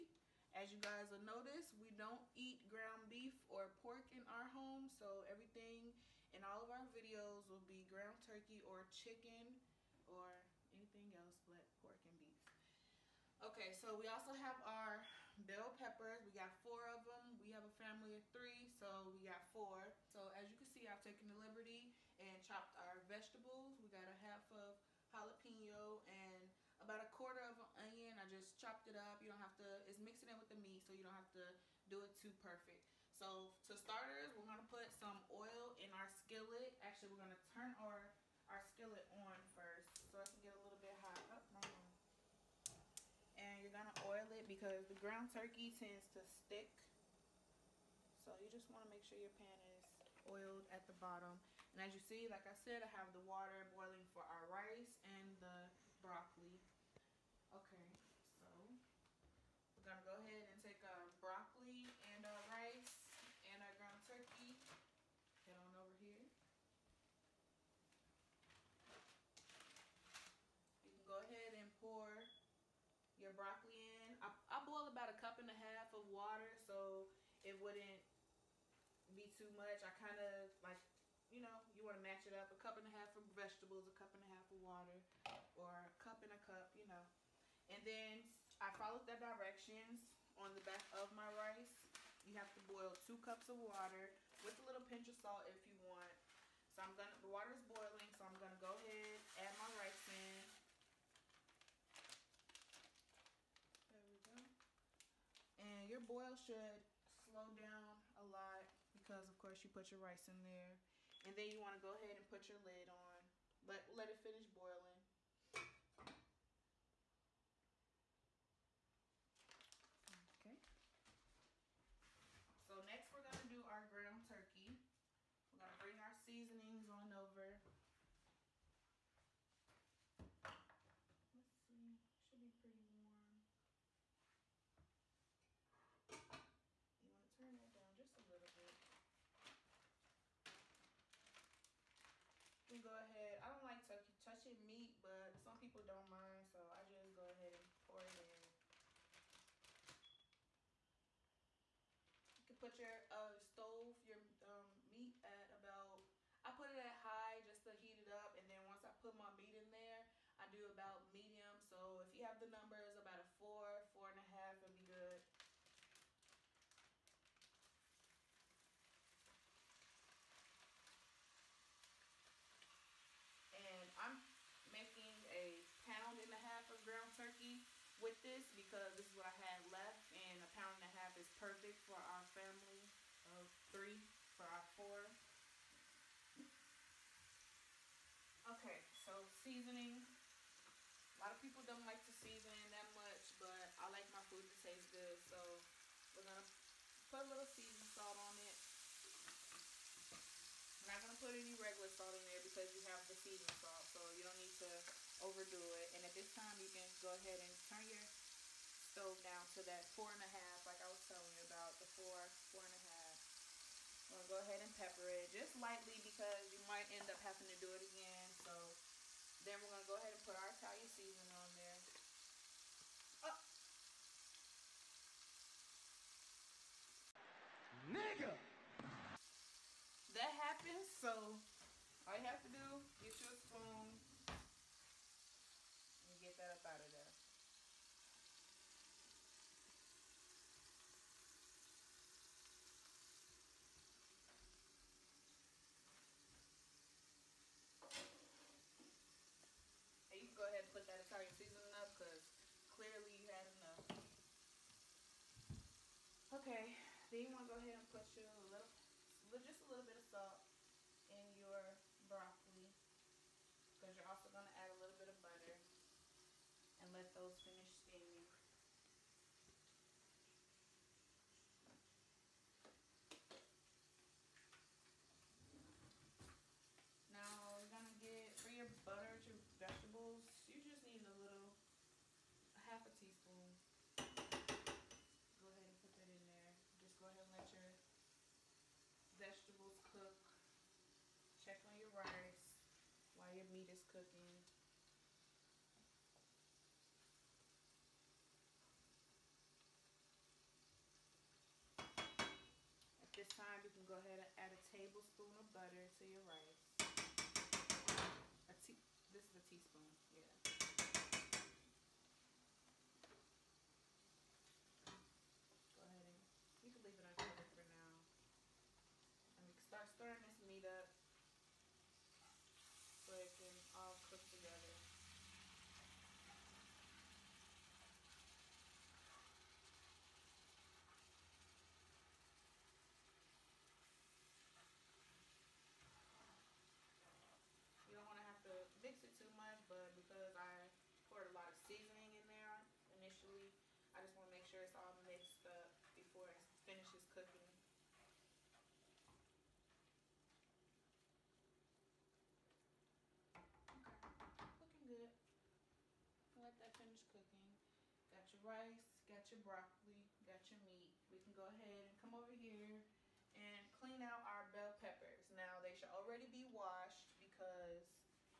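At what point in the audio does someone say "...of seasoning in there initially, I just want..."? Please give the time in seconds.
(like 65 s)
341 s.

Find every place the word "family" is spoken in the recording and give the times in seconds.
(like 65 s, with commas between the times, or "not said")
17 s, 182 s.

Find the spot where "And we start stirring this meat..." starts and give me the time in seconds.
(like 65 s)
319 s.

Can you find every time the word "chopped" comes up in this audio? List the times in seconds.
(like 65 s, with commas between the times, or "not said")
22 s, 28 s.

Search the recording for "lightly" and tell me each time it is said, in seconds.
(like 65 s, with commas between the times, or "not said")
215 s.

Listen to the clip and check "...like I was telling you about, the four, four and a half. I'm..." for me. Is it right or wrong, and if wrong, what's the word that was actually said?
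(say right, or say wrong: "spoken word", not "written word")
right.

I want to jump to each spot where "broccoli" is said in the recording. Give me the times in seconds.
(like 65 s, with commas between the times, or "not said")
56 s, 61 s, 73 s, 262 s, 359 s.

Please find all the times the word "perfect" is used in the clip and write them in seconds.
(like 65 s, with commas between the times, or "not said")
32 s, 181 s.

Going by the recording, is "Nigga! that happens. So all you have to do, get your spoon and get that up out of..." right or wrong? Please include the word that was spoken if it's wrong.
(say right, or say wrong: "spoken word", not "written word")
right.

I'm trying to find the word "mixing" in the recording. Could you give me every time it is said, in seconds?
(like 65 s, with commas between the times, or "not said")
29 s.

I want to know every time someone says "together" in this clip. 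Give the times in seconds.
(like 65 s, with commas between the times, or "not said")
324 s.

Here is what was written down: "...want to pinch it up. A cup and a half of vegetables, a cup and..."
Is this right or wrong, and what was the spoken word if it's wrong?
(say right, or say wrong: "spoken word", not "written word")
wrong: "match", not "pinch".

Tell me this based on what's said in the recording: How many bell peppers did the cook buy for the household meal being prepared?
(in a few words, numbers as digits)
4.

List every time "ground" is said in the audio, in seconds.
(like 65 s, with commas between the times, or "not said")
2 s, 7 s, 44 s, 63 s, 123 s, 176 s.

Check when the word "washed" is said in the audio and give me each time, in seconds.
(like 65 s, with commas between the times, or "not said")
366 s.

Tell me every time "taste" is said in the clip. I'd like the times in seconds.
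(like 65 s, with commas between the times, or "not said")
194 s.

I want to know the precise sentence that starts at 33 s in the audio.
So to starters, we're gonna put some oil in our skillet.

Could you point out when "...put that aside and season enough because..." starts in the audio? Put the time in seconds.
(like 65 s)
250 s.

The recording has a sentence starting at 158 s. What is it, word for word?
And then once I put my meat in there, I do about medium.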